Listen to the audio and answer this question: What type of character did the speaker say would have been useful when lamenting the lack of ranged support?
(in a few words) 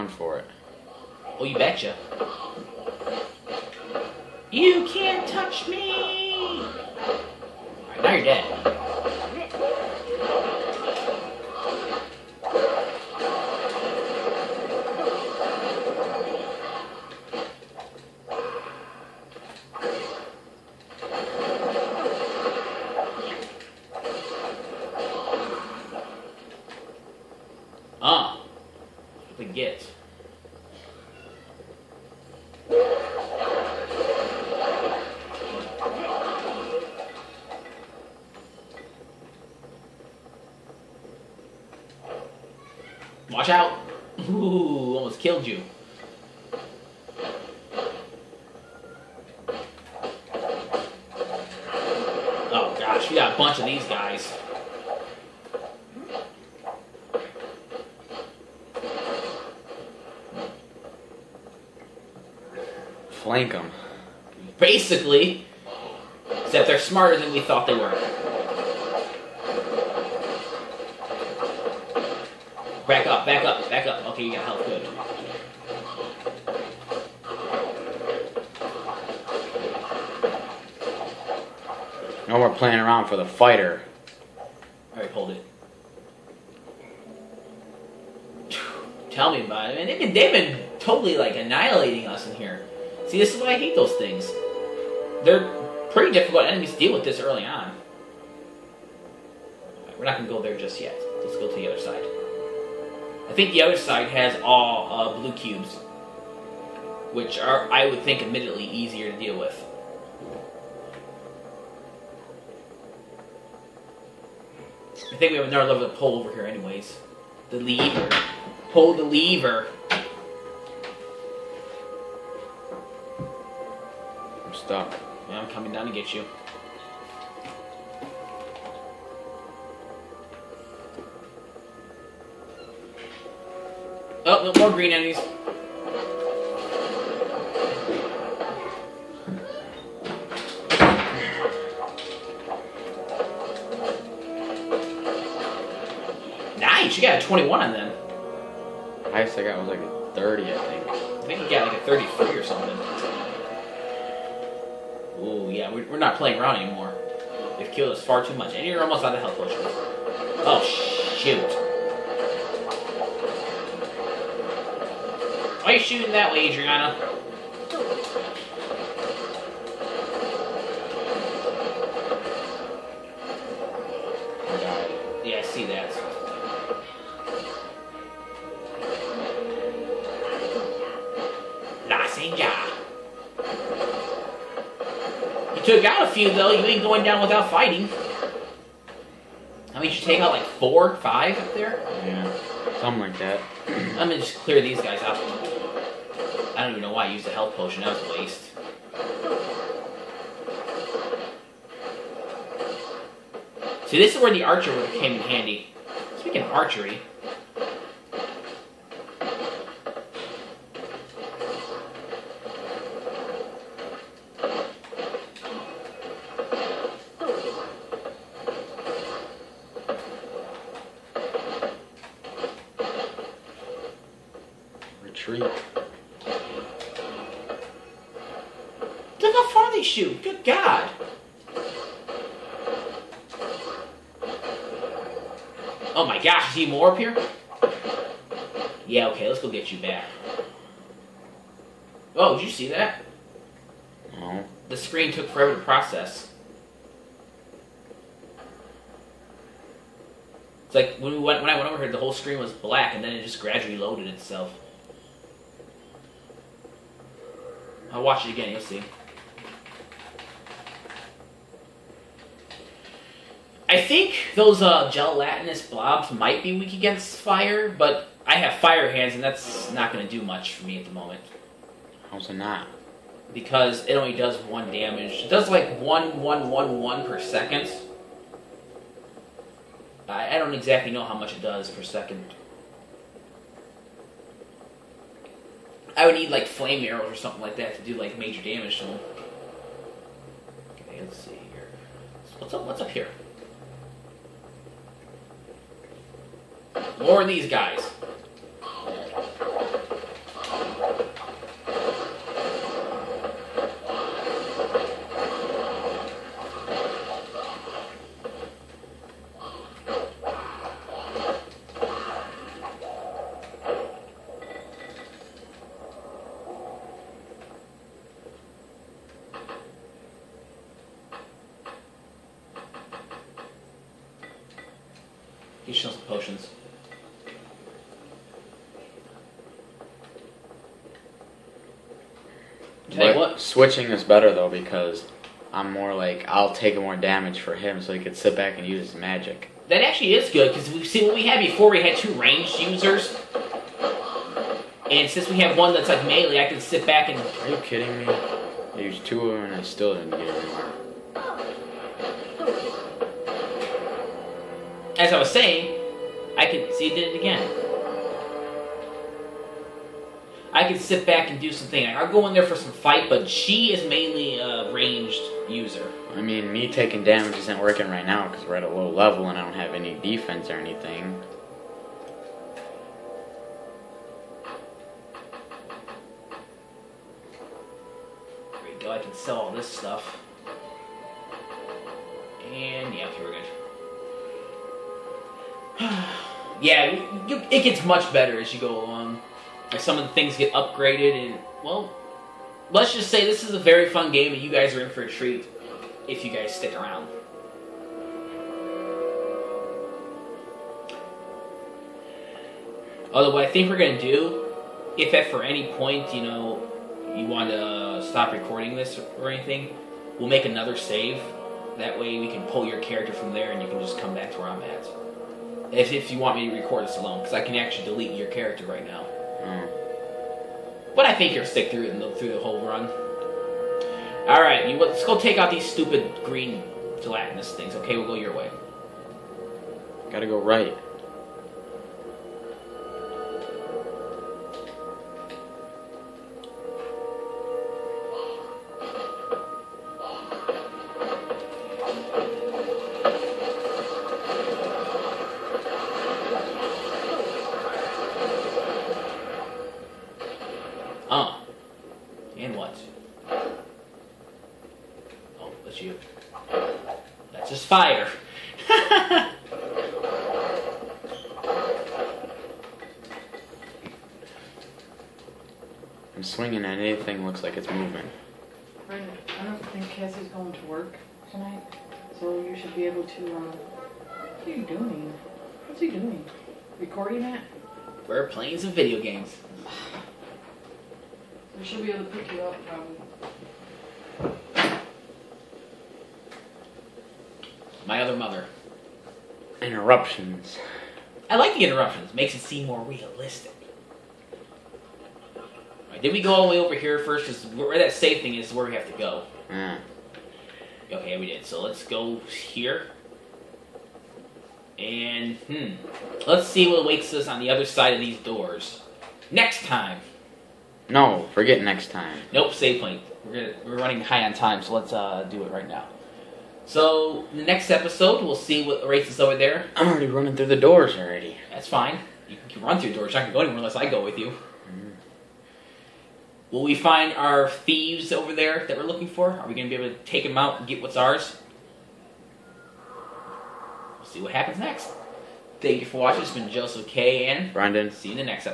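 Archer.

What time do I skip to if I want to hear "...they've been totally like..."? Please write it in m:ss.
1:30.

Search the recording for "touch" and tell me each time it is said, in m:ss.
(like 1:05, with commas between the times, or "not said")
0:05.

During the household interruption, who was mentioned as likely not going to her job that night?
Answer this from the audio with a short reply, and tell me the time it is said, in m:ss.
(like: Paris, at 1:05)
Cassie, at 7:49.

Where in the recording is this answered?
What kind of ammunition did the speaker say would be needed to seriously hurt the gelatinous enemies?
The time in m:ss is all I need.
4:46.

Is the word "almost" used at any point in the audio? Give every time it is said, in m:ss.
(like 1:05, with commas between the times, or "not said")
0:44, 2:38.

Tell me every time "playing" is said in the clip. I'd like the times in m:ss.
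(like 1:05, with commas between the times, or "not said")
1:22, 2:36, 7:58.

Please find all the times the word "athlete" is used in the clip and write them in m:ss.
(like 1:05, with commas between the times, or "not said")
not said.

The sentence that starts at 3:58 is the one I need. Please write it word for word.
Yeah, okay, let's go get you back.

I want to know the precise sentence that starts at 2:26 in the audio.
Nice, you got a 21 on them.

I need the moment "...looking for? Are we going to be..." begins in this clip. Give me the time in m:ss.
8:48.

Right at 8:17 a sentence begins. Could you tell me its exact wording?
Because where that safe thing is where we have to go.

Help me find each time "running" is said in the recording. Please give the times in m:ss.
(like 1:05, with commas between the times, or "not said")
8:33, 8:40.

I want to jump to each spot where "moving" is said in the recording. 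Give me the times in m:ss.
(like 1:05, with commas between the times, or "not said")
7:47.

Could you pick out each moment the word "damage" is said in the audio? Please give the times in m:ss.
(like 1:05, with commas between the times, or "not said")
4:34, 4:48, 5:36, 6:07.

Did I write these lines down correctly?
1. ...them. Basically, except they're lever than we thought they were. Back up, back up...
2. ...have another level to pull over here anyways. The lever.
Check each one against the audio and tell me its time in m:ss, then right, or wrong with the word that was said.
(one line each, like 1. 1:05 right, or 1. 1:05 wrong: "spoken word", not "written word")
1. 1:03 wrong: "smarter", not "lever"
2. 1:55 right.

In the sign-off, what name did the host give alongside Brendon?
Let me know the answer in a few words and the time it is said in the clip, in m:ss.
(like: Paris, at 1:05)
Joseph K., at 8:56.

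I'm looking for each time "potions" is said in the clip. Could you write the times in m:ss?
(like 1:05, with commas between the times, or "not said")
2:39, 3:17.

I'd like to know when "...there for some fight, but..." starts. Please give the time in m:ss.
6:02.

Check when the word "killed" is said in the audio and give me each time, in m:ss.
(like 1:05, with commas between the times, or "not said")
0:45, 2:37.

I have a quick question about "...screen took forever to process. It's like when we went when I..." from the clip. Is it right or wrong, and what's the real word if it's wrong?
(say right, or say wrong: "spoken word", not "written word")
right.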